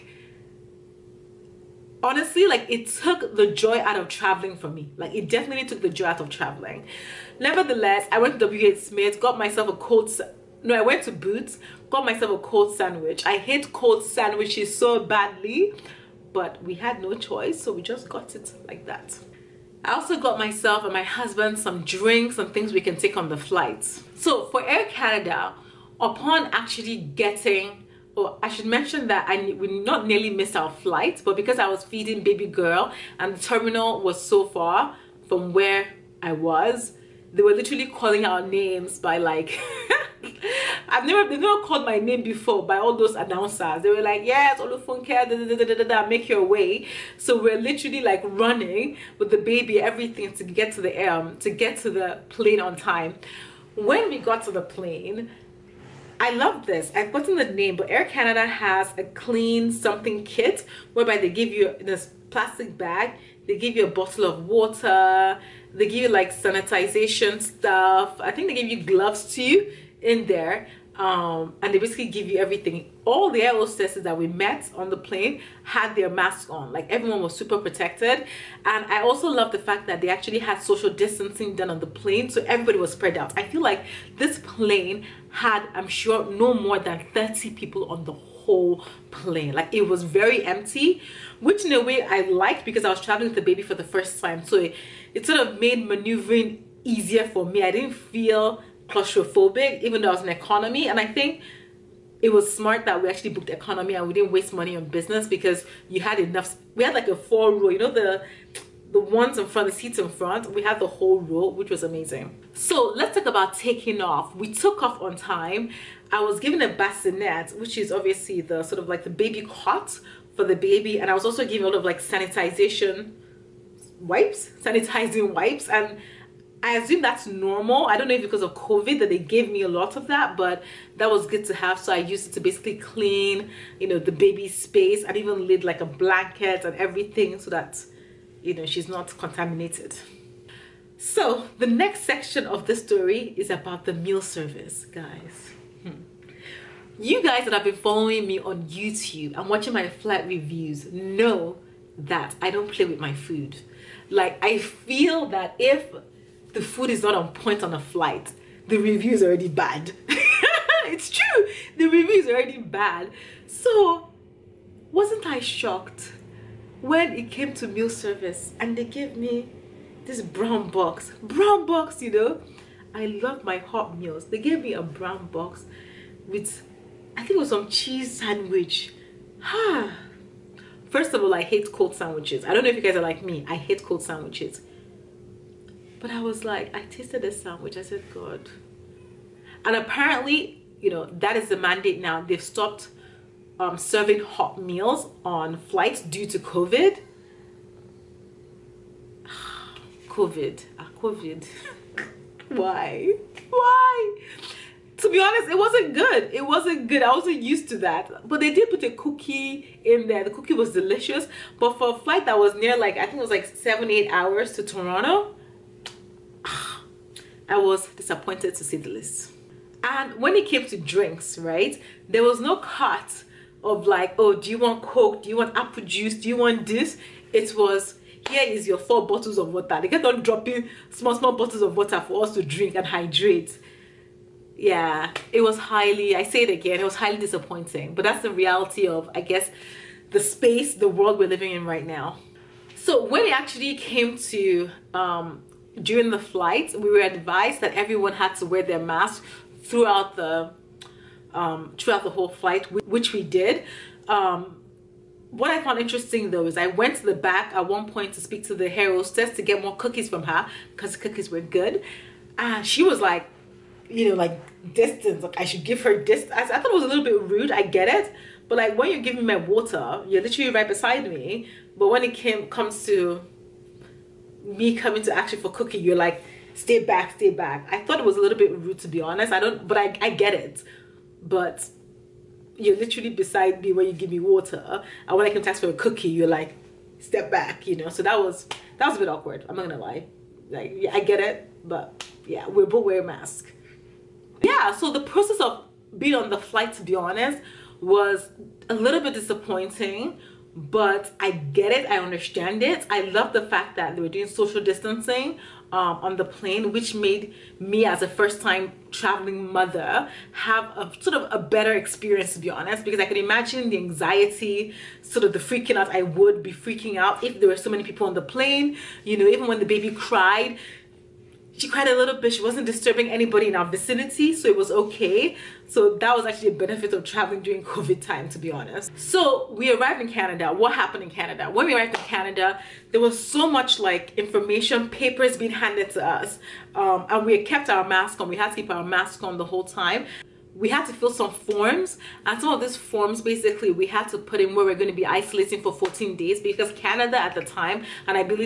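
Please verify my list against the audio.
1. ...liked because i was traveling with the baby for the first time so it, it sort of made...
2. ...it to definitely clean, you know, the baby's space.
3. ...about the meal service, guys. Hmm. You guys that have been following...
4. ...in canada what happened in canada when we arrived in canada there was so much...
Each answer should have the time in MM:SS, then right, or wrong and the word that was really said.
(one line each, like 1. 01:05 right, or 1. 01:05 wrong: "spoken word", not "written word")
1. 01:32 right
2. 02:12 wrong: "basically", not "definitely"
3. 02:23 right
4. 05:30 right.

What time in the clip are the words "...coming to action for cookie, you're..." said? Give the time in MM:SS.
04:34.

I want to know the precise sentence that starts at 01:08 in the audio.
I think they give you gloves too in there um, and they basically give you everything.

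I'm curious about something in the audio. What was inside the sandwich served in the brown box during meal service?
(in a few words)
cheese.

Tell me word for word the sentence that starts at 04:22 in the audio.
And ah, she was like, you know, like distance, like I should give her distance.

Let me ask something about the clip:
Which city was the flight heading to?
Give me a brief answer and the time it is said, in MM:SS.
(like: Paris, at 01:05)
Toronto, at 03:34.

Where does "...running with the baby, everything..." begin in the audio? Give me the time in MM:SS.
00:48.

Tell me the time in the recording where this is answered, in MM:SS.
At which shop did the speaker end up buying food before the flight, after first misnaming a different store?
00:11.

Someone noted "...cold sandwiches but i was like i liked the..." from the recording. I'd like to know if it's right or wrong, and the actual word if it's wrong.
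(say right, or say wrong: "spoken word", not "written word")
wrong: "tasted", not "liked".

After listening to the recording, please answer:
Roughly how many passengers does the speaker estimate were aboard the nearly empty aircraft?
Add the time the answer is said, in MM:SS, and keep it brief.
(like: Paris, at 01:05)
30, at 01:27.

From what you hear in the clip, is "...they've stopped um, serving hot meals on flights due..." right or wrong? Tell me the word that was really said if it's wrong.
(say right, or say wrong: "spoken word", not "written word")
right.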